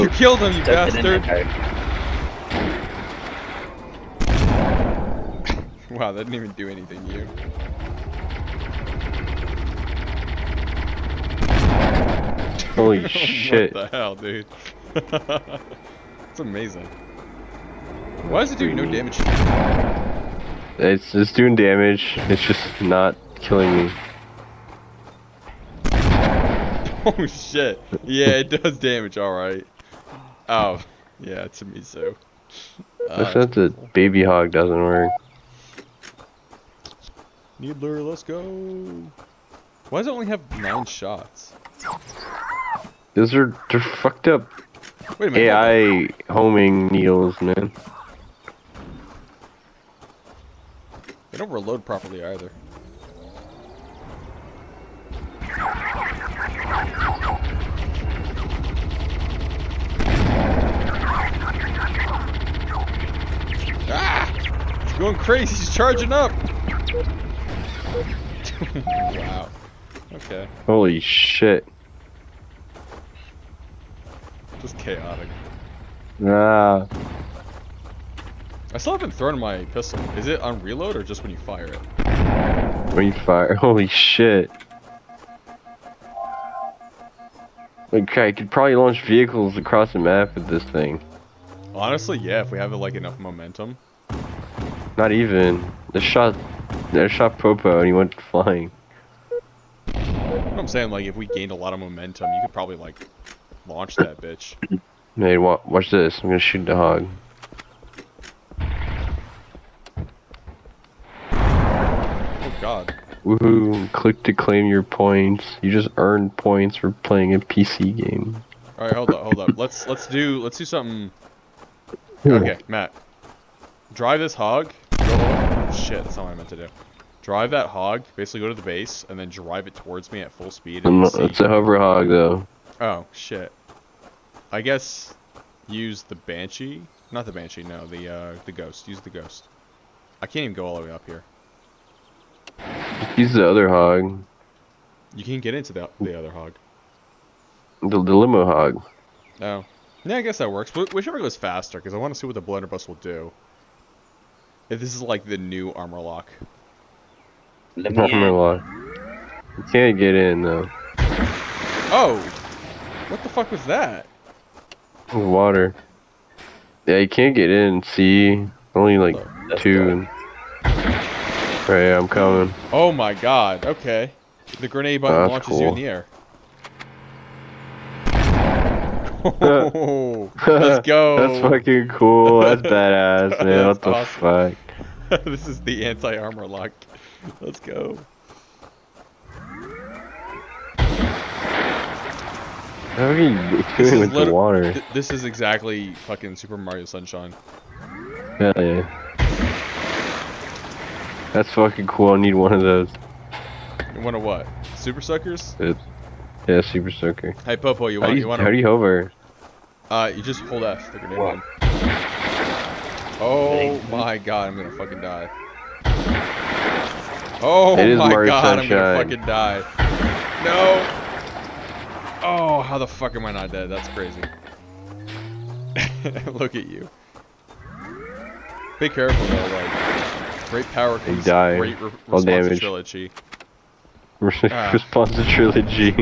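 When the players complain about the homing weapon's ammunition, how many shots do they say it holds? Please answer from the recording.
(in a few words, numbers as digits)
9.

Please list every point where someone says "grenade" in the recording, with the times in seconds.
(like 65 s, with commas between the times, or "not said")
174 s, 210 s.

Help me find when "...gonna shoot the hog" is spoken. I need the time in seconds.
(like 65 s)
106 s.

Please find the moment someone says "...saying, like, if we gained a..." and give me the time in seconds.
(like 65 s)
100 s.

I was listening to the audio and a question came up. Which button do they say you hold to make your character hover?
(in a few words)
F.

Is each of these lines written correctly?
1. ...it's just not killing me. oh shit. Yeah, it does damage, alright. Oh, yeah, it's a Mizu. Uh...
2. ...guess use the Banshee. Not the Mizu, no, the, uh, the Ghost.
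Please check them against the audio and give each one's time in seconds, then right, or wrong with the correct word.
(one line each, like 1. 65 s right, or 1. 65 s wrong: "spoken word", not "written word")
1. 22 s right
2. 134 s wrong: "Banshee", not "Mizu".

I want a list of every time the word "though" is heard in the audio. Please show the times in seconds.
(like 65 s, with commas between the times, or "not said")
132 s, 160 s, 229 s.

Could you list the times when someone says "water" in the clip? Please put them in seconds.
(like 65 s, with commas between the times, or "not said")
165 s, 194 s.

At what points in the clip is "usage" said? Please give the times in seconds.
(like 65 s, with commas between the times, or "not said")
not said.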